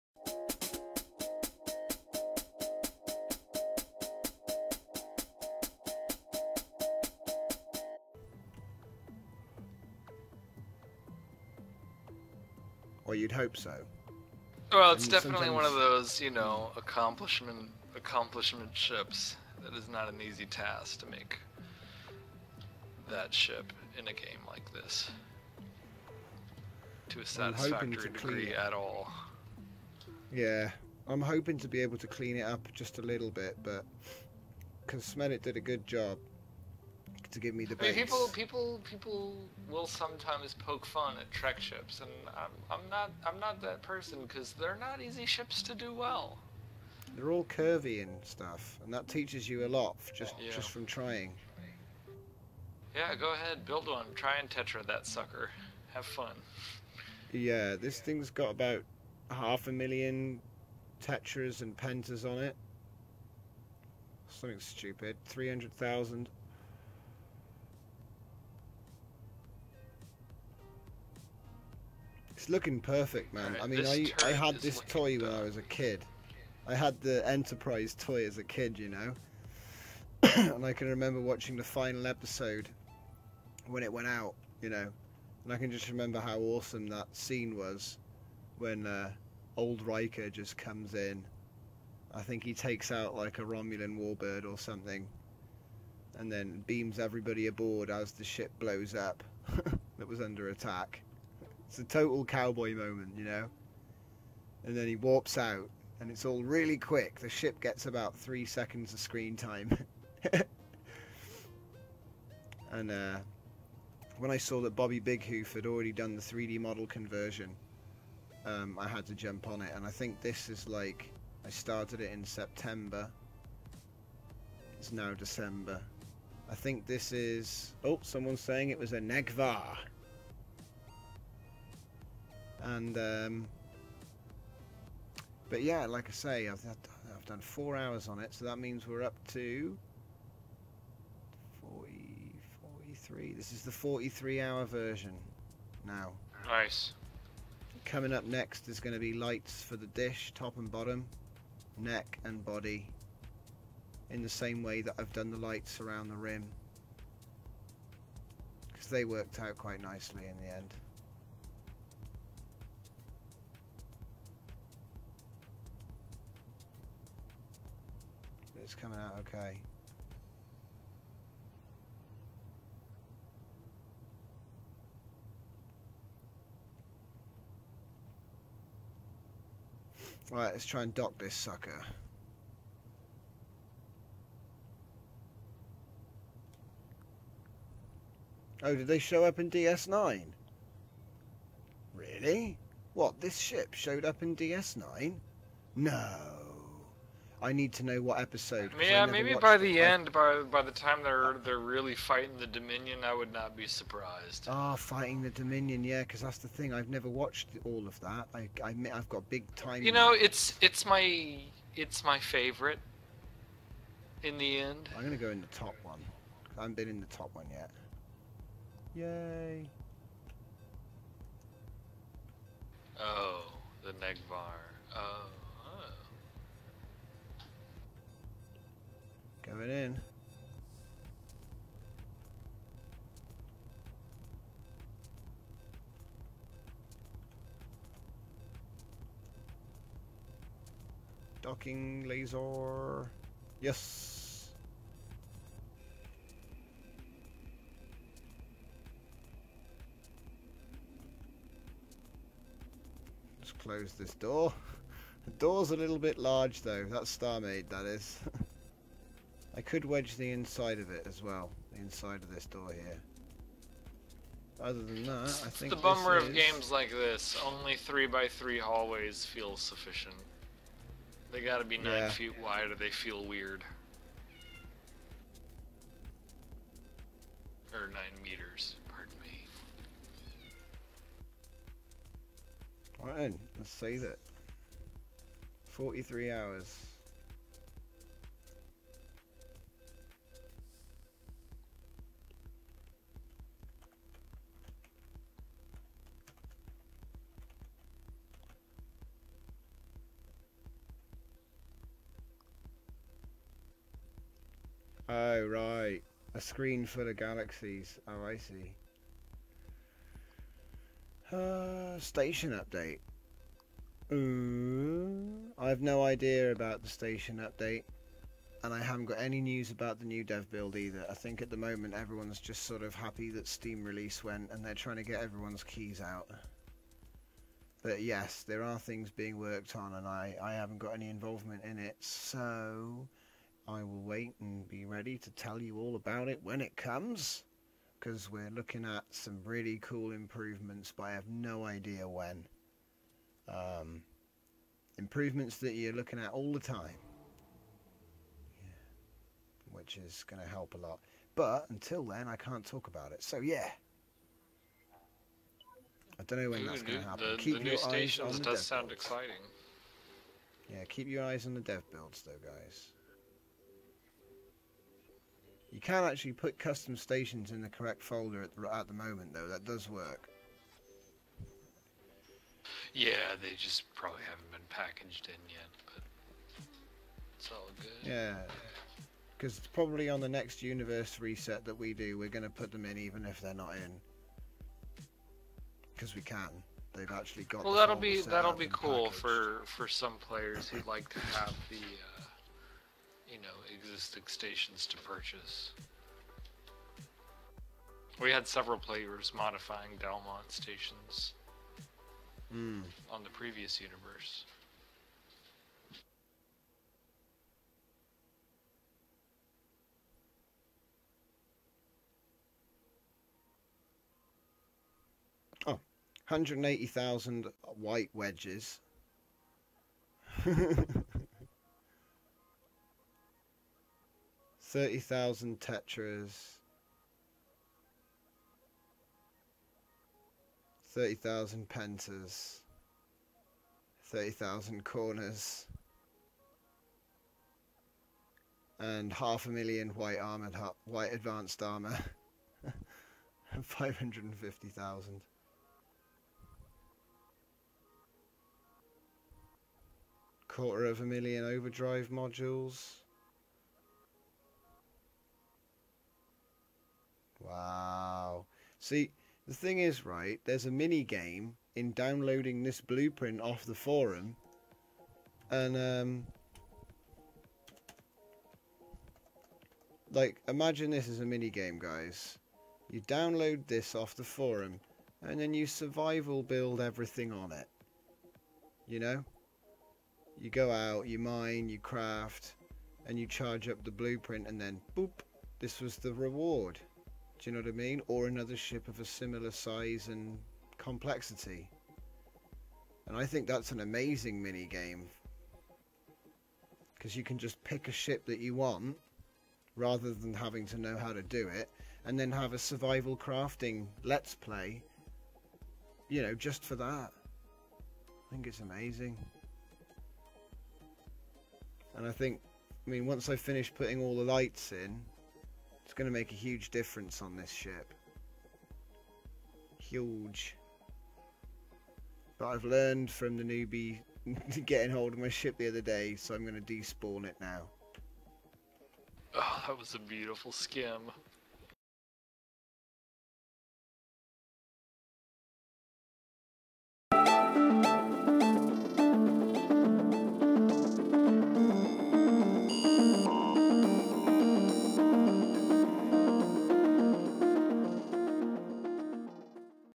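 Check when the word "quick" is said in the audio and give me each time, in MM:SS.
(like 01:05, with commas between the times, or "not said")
01:46.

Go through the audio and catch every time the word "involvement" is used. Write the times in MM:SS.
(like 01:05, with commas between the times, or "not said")
05:31.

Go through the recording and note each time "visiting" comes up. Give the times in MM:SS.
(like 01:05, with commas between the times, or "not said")
not said.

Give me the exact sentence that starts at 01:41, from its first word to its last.
It's a total cowboy moment, you know.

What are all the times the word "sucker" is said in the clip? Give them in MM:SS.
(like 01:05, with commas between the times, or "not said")
00:55, 03:01.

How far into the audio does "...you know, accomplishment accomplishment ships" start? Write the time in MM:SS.
00:16.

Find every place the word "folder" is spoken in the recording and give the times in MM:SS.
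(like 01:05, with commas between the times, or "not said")
06:08.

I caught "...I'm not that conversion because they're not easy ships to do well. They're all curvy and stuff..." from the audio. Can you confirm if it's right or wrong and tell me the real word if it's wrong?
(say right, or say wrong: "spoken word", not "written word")
wrong: "person", not "conversion".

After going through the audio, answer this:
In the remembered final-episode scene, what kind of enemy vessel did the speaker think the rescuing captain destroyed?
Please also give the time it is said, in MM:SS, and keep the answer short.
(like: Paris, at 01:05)
Romulan warbird, at 01:33.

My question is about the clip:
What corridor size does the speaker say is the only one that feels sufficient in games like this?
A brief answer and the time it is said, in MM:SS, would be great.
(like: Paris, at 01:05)
3 by 3, at 04:27.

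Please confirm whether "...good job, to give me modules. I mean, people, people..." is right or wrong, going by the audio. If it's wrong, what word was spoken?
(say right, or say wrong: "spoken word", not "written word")
wrong: "debates", not "modules".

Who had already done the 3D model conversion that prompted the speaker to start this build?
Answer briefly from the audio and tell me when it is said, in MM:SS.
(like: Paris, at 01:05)
Bobby Big Hoof, at 01:54.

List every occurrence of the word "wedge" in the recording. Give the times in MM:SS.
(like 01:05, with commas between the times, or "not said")
04:19, 06:58.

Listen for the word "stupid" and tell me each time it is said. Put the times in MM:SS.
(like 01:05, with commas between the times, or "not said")
01:04.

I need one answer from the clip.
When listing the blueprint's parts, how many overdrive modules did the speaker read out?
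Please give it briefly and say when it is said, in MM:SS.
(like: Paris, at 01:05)
Quarter of a million, at 07:30.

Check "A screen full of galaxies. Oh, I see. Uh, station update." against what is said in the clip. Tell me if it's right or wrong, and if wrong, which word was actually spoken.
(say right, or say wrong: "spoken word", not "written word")
right.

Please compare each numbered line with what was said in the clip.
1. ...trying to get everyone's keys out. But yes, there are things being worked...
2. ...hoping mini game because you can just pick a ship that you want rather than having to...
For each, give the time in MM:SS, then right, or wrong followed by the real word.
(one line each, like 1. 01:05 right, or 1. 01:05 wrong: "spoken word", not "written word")
1. 05:24 right
2. 08:13 wrong: "amazing", not "hoping".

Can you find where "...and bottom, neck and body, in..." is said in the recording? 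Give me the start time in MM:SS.
02:30.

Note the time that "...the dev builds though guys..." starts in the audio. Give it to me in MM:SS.
06:01.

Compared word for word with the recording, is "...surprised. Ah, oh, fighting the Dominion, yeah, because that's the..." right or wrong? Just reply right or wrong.
right.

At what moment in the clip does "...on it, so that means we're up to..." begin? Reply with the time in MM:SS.
02:18.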